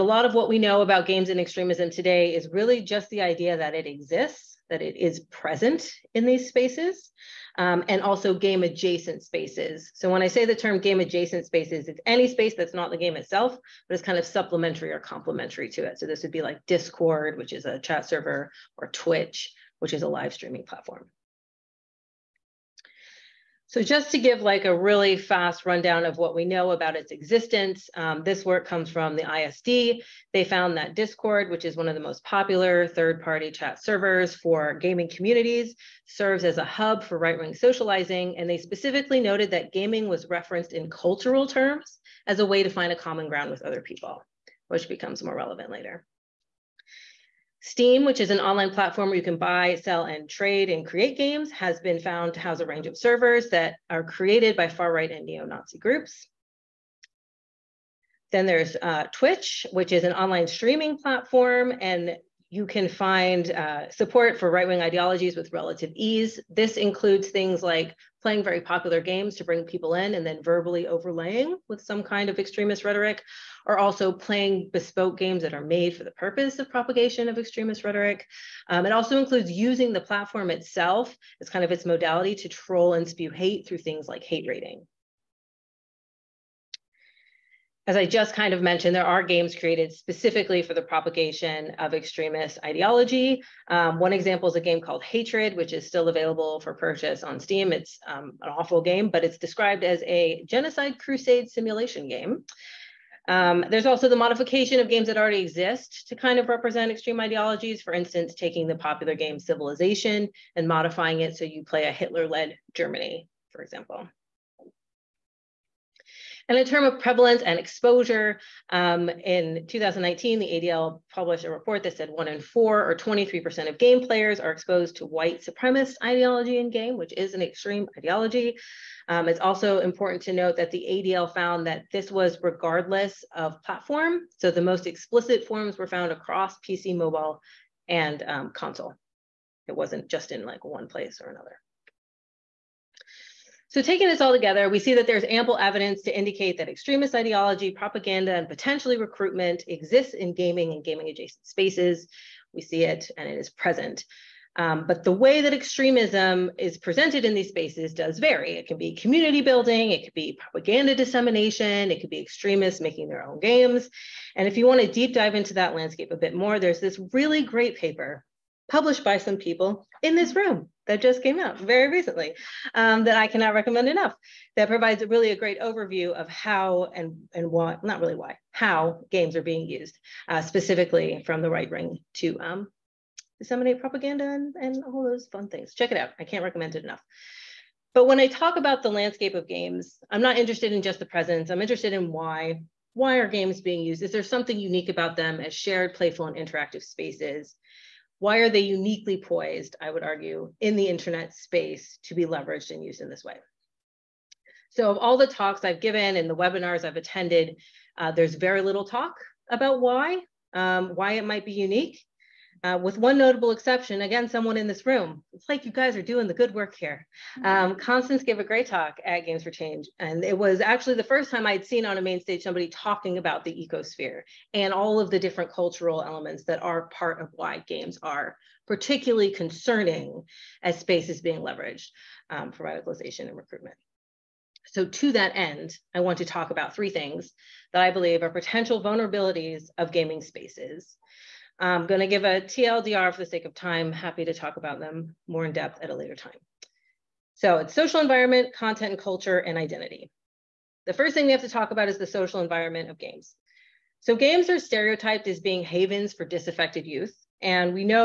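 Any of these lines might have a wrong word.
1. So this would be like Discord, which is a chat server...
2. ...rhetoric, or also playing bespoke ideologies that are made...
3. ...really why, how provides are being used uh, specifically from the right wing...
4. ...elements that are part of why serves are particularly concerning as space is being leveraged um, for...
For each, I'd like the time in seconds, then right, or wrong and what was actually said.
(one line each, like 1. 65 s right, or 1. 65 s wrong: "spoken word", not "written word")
1. 15 s right
2. 72 s wrong: "games", not "ideologies"
3. 177 s wrong: "games", not "provides"
4. 226 s wrong: "games", not "serves".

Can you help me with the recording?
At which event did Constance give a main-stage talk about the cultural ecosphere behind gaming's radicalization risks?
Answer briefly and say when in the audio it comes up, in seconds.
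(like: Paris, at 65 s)
Games for Change, at 219 s.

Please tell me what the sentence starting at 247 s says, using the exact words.
So it's social environment, content and culture, and identity.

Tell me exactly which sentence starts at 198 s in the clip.
why are they uniquely poised, I would argue, in the internet space to be leveraged and used in this way?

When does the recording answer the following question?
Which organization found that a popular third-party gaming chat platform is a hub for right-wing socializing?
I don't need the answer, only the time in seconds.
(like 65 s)
29 s.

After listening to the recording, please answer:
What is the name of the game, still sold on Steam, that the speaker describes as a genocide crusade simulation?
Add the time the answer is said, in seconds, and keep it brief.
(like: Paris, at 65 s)
Hatred, at 95 s.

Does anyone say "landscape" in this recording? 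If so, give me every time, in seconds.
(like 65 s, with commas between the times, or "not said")
165 s, 188 s.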